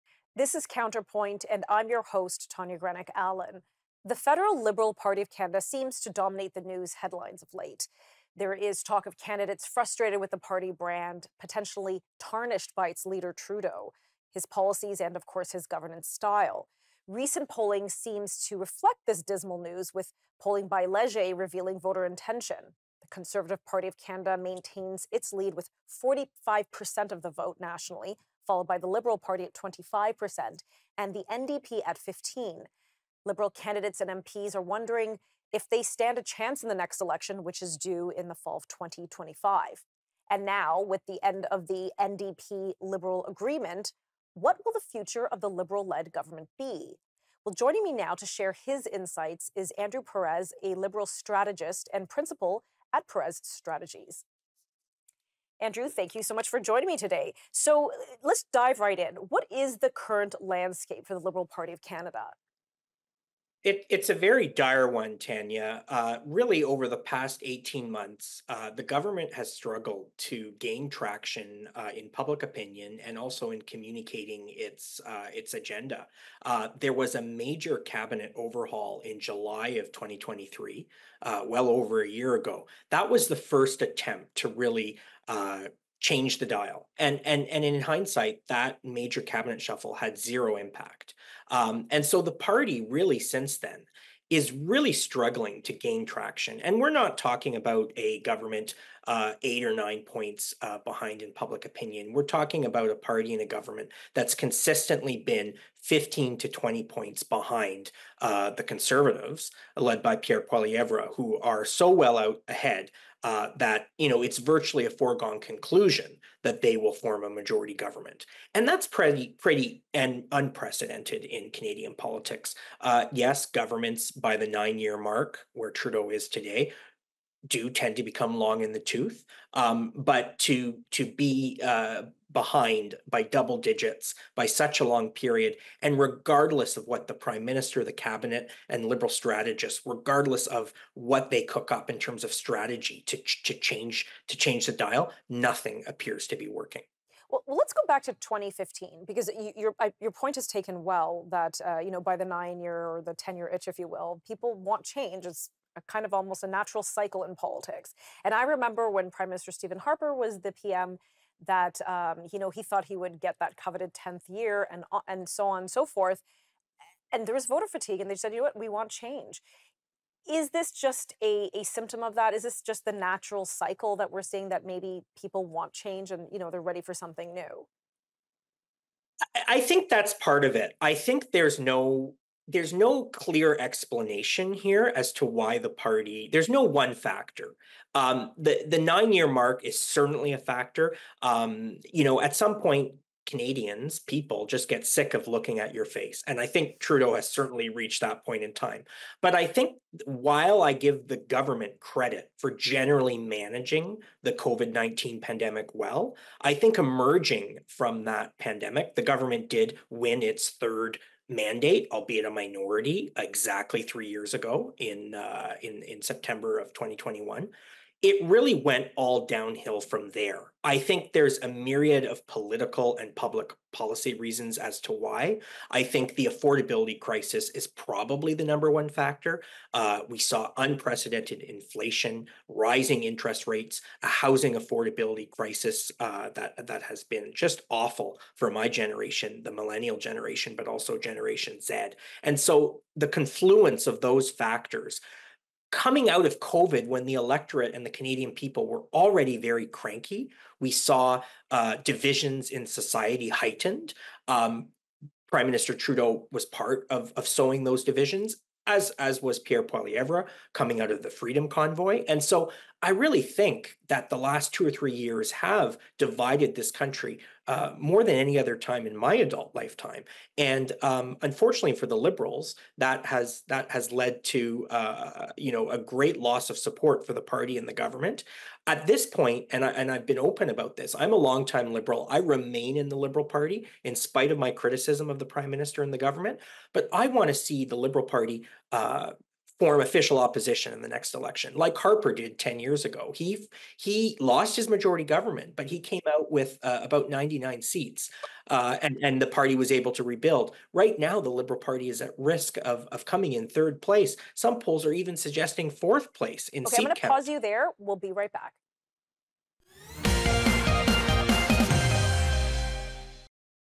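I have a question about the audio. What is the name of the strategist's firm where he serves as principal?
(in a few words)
Perez Strategies.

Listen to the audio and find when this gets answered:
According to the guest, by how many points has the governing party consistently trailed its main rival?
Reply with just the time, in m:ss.
1:45.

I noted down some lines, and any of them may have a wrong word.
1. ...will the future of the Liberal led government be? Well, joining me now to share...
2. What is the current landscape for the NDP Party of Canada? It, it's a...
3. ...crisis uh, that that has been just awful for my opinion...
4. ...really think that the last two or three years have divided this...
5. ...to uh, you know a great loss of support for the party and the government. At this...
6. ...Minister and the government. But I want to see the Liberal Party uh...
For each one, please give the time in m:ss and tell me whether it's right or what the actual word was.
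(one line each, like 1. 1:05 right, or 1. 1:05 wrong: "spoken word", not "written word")
1. 0:44 right
2. 0:59 wrong: "Liberal", not "NDP"
3. 3:55 wrong: "generation", not "opinion"
4. 4:22 right
5. 4:34 right
6. 4:45 right.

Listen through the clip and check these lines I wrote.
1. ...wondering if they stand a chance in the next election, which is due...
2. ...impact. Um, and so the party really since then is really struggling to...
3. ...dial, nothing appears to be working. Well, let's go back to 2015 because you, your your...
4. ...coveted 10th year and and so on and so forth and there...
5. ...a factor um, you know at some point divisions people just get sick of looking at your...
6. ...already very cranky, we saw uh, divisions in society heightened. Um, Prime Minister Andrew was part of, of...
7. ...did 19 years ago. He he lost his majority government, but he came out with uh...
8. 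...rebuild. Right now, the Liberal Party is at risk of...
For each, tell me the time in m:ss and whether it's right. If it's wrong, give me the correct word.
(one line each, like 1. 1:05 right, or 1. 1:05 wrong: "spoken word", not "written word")
1. 0:34 right
2. 1:30 right
3. 2:24 right
4. 2:43 right
5. 3:10 wrong: "canadians", not "divisions"
6. 4:08 wrong: "Trudeau", not "Andrew"
7. 4:52 wrong: "10", not "19"
8. 5:00 right.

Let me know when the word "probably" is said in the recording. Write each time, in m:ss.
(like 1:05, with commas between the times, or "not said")
3:47.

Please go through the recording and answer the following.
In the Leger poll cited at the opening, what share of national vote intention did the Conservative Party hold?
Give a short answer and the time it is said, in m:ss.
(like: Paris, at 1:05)
45%, at 0:26.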